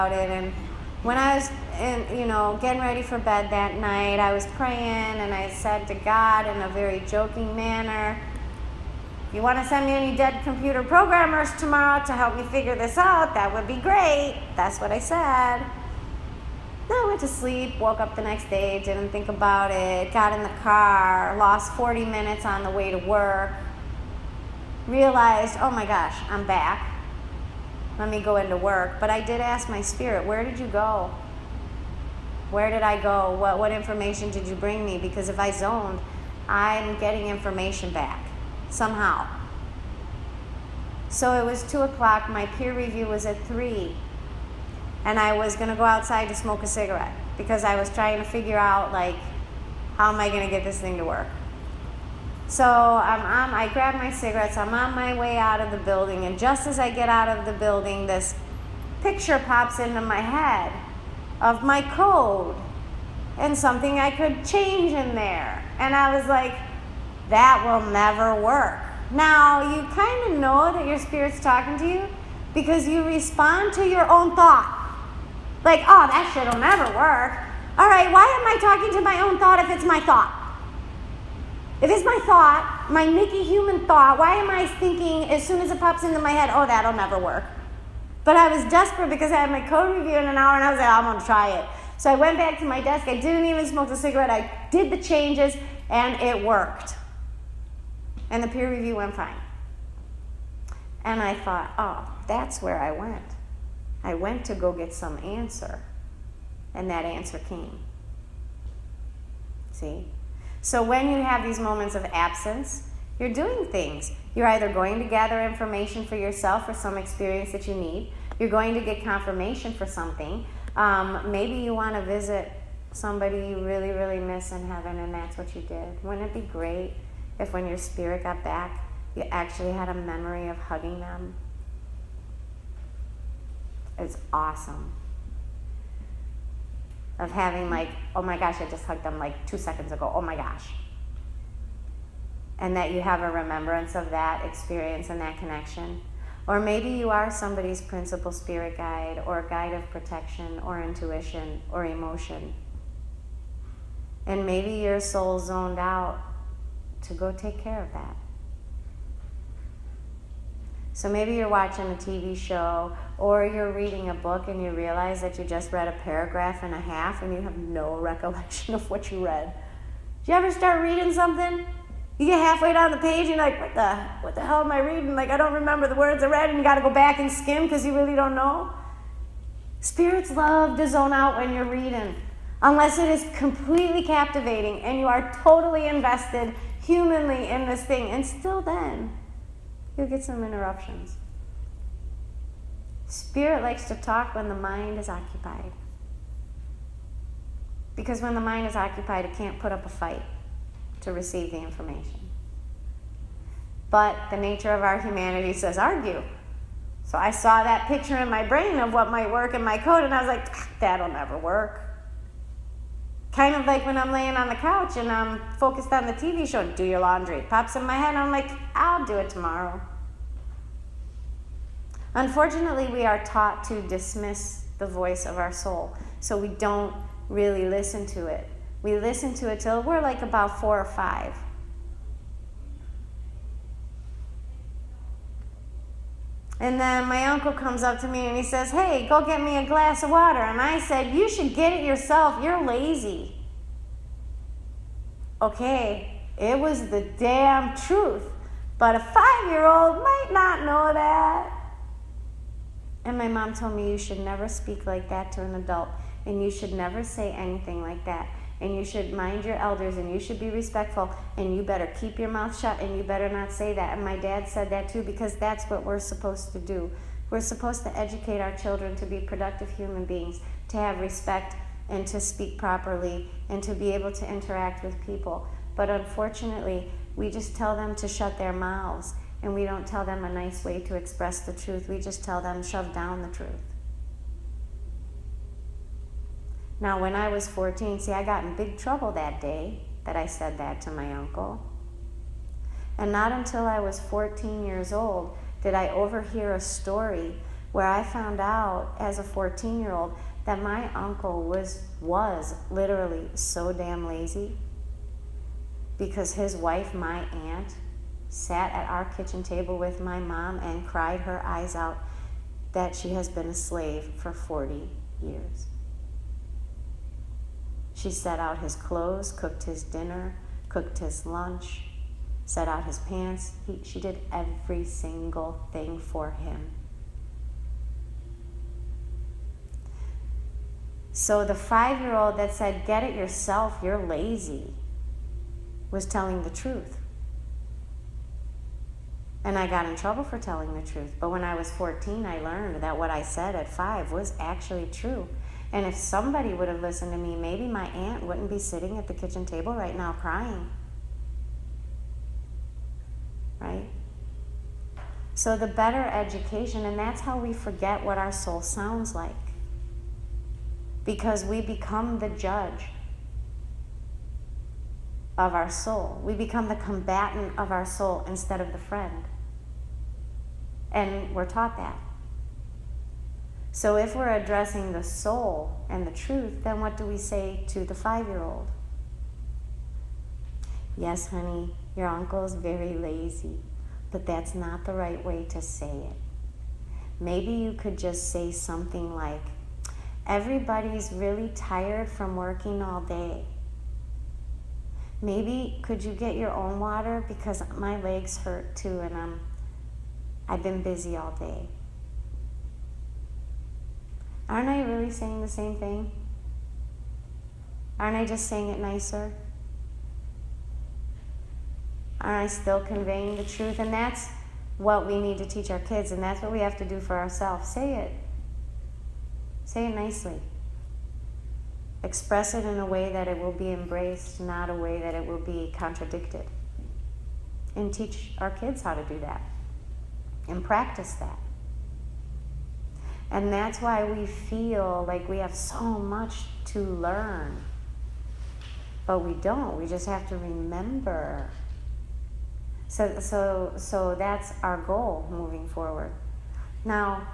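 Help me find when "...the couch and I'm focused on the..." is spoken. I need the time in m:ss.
3:34.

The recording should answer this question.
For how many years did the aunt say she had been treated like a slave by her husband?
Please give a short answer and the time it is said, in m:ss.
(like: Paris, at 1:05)
40 years, at 5:14.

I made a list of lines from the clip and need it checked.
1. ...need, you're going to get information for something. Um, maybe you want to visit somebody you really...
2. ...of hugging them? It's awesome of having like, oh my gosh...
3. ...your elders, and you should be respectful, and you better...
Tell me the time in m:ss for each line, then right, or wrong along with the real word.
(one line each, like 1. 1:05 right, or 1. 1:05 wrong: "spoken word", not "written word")
1. 1:57 wrong: "confirmation", not "information"
2. 2:10 right
3. 4:19 right.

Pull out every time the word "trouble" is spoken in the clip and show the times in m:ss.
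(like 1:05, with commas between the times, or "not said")
4:48, 5:39.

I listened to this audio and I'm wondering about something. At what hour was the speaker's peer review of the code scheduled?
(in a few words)
3.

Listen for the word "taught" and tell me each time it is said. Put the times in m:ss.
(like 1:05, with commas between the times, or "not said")
3:43, 6:11.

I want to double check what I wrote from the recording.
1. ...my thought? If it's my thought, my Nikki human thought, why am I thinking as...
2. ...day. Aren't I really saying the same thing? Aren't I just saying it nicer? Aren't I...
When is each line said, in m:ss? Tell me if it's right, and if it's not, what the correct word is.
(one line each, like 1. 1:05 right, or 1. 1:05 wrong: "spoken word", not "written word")
1. 1:19 right
2. 6:41 right.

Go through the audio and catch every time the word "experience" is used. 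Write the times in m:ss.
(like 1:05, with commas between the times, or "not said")
1:56, 2:24.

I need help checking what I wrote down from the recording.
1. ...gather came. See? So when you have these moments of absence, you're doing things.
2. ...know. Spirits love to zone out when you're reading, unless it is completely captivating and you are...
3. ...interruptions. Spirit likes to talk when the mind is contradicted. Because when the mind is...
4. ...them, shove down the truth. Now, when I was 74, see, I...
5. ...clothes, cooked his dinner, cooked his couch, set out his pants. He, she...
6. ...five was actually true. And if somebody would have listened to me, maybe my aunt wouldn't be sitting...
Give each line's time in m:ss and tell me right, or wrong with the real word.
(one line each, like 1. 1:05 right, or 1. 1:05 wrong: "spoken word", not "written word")
1. 1:47 wrong: "answer", not "gather"
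2. 2:58 right
3. 3:10 wrong: "occupied", not "contradicted"
4. 4:42 wrong: "14", not "74"
5. 5:18 wrong: "lunch", not "couch"
6. 5:43 right.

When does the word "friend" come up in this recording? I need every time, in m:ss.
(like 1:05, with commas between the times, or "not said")
6:08.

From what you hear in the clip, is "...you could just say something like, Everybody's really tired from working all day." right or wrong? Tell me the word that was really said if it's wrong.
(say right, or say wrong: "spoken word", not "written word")
right.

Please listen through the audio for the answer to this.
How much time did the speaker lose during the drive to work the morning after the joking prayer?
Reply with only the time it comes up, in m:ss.
0:21.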